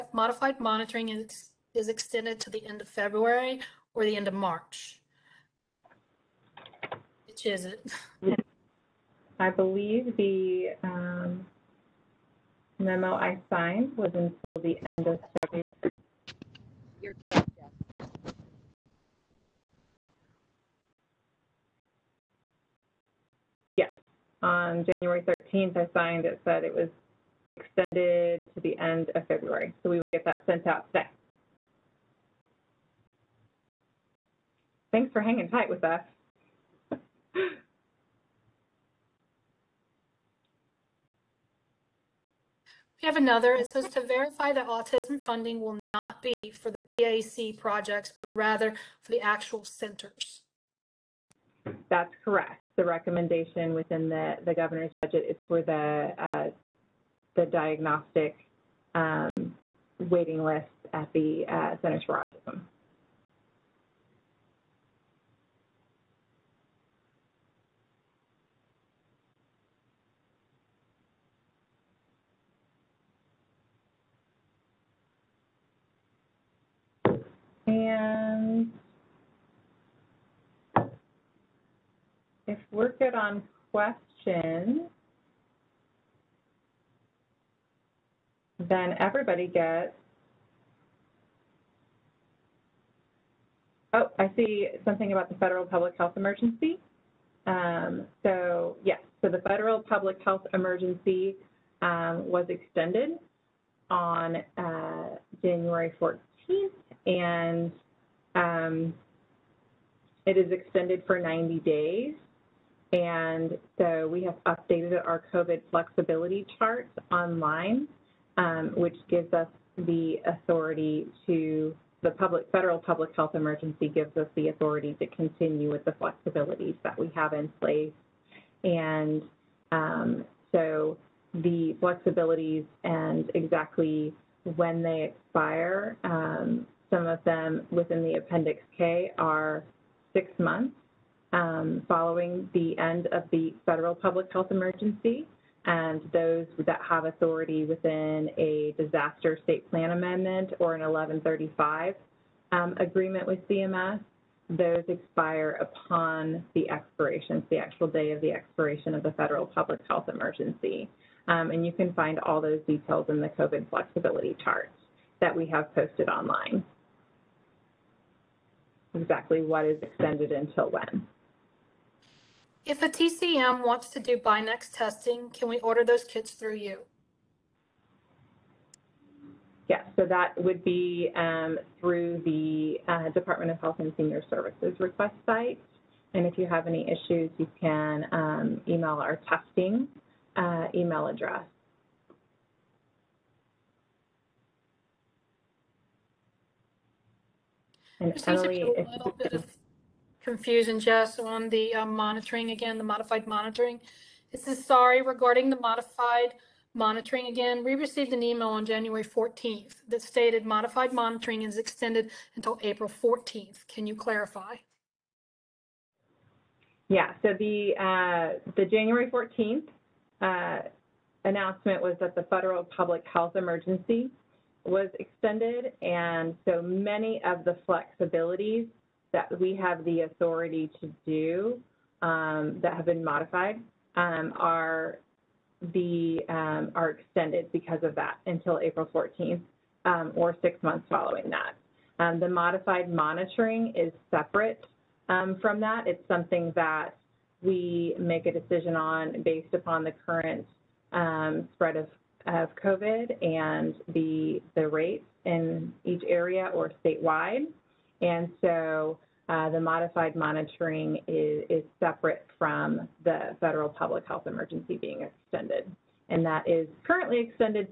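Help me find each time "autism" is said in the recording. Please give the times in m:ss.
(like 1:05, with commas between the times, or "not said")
0:44, 1:02.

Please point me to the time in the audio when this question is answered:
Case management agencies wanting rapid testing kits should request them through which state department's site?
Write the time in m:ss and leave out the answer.
3:03.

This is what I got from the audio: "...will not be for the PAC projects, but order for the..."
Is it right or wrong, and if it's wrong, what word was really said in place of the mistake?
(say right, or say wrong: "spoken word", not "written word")
wrong: "rather", not "order".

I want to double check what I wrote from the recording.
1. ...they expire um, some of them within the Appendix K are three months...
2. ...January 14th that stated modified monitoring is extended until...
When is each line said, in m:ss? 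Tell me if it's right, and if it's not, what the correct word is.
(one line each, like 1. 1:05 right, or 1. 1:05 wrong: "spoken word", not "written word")
1. 2:14 wrong: "six", not "three"
2. 3:28 right.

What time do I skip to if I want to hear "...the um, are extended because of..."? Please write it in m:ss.
3:55.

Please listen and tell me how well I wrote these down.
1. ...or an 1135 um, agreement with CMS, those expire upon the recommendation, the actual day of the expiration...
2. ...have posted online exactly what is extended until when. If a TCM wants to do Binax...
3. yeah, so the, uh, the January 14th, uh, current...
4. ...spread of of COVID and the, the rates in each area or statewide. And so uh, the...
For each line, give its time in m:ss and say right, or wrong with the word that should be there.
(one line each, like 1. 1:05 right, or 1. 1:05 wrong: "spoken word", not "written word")
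1. 2:30 wrong: "expiration", not "recommendation"
2. 2:45 right
3. 3:36 wrong: "announcement", not "current"
4. 4:11 right.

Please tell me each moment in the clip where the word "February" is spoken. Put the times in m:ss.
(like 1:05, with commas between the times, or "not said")
0:02, 0:15, 0:29.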